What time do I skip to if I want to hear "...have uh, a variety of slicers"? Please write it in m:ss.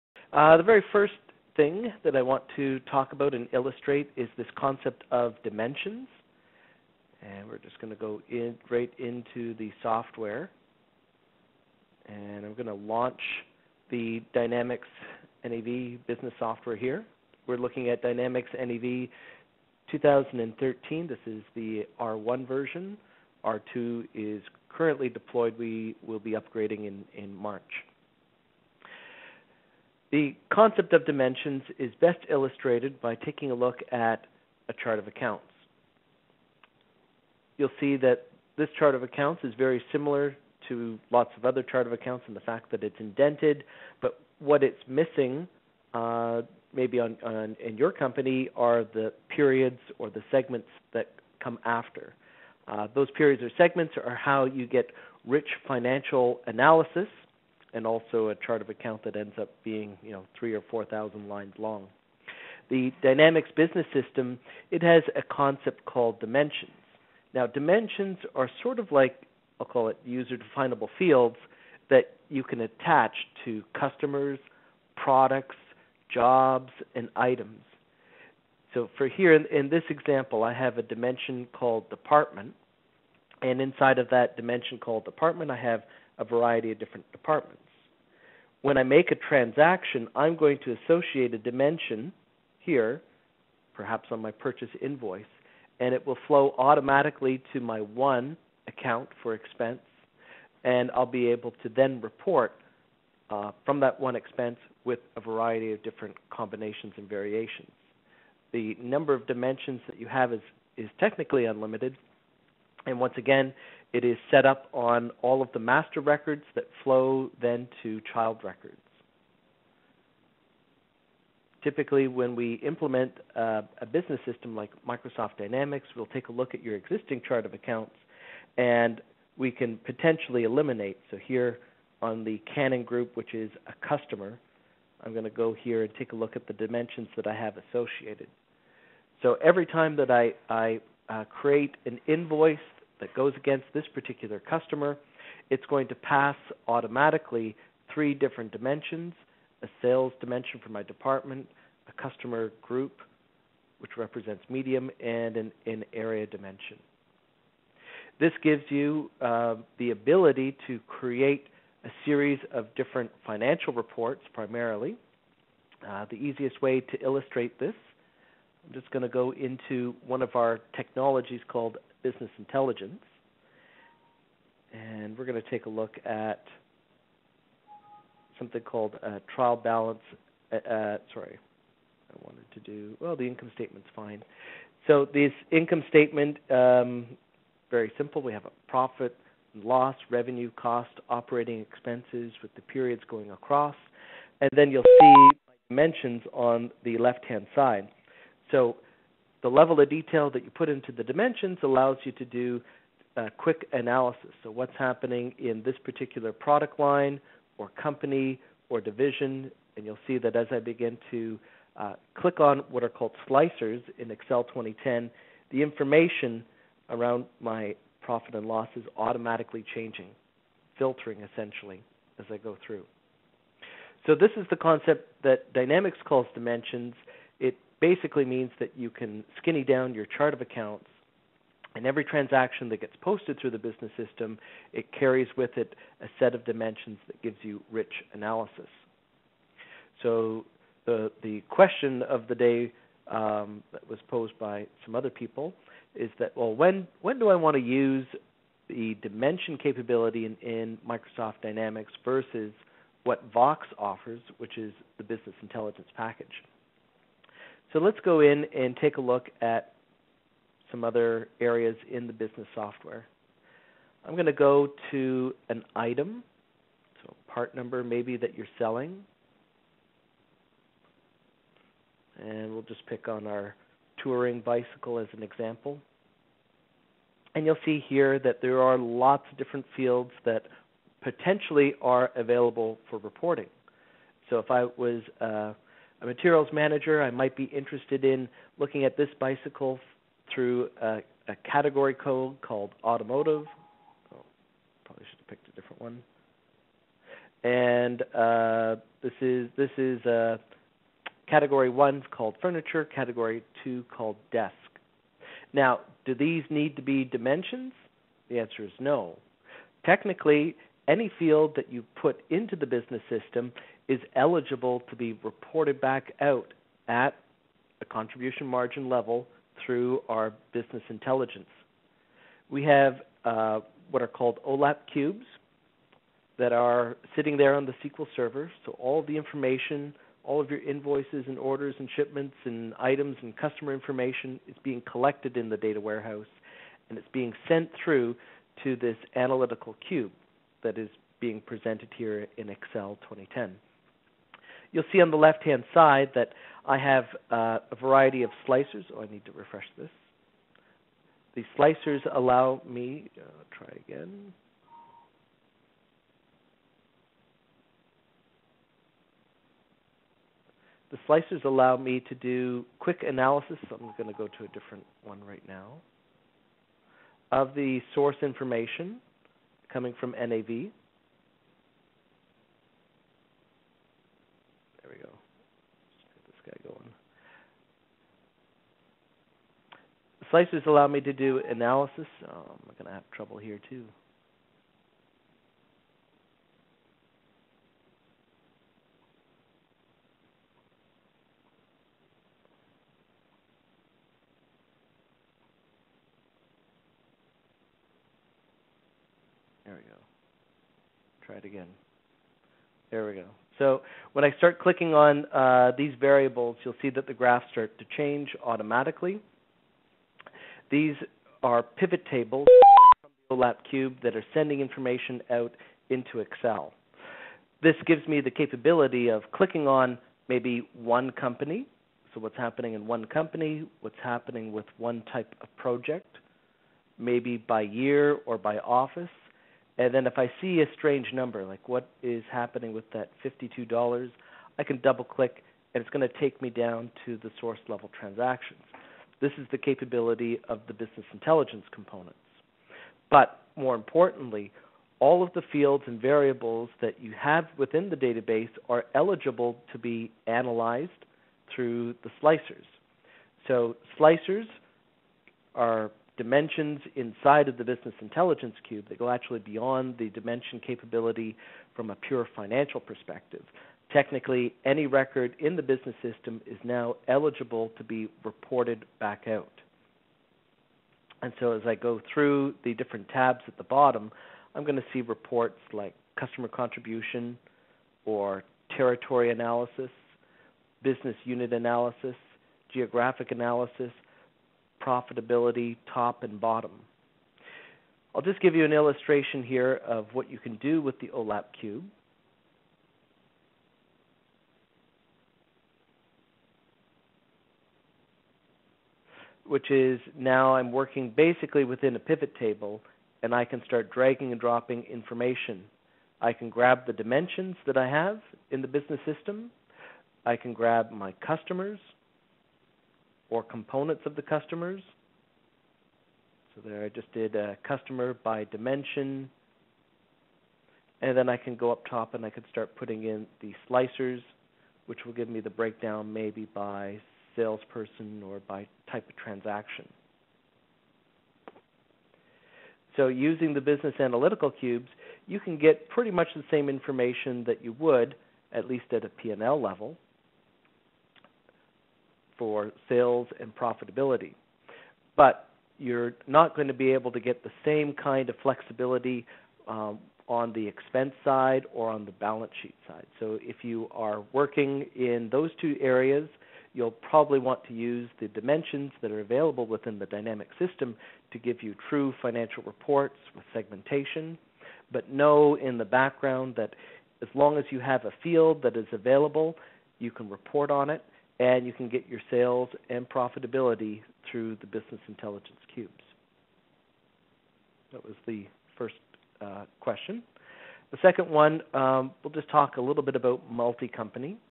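5:46.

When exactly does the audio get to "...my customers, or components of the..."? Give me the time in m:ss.
8:30.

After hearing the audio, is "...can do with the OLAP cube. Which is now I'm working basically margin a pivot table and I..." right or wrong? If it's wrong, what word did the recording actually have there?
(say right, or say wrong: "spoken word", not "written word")
wrong: "within", not "margin".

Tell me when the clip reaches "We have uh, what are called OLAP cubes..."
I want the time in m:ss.
5:22.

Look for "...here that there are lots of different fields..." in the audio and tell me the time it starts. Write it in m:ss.
4:37.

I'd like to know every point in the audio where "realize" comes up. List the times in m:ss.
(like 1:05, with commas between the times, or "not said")
not said.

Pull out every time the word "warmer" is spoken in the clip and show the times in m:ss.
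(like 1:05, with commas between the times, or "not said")
not said.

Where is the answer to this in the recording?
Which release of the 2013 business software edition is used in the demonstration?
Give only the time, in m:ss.
0:21.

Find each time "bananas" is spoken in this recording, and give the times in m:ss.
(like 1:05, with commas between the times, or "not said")
not said.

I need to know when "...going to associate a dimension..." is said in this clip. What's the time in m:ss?
1:30.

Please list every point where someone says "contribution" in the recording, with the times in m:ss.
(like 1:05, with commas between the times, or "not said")
5:17, 7:56.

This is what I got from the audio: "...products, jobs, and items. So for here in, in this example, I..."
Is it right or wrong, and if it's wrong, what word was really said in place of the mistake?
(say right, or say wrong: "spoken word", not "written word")
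right.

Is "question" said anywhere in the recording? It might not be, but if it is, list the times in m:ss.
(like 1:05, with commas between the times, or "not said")
4:01, 9:39.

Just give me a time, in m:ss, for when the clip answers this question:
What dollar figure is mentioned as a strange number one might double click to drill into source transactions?
7:13.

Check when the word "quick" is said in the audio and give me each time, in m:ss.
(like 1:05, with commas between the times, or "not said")
3:23, 6:02.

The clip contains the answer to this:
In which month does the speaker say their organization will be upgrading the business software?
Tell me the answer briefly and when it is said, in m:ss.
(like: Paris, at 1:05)
March, at 0:27.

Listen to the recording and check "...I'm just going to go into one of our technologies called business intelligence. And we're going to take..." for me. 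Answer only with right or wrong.
right.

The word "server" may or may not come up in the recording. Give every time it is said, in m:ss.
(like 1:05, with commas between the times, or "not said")
5:28.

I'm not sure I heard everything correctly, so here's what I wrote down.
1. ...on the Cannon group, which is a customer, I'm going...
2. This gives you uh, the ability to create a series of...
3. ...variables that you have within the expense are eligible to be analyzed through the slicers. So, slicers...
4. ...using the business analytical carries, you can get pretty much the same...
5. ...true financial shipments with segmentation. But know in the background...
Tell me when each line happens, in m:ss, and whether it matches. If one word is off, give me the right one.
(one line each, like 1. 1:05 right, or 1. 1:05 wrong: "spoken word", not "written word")
1. 2:12 right
2. 2:38 right
3. 7:25 wrong: "database", not "expense"
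4. 8:53 wrong: "cubes", not "carries"
5. 9:21 wrong: "reports", not "shipments".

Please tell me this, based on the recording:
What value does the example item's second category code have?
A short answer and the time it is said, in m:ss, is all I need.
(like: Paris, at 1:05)
desk, at 5:04.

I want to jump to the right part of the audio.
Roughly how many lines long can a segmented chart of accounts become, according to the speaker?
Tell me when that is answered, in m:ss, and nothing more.
1:00.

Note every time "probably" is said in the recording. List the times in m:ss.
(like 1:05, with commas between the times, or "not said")
4:54, 9:16.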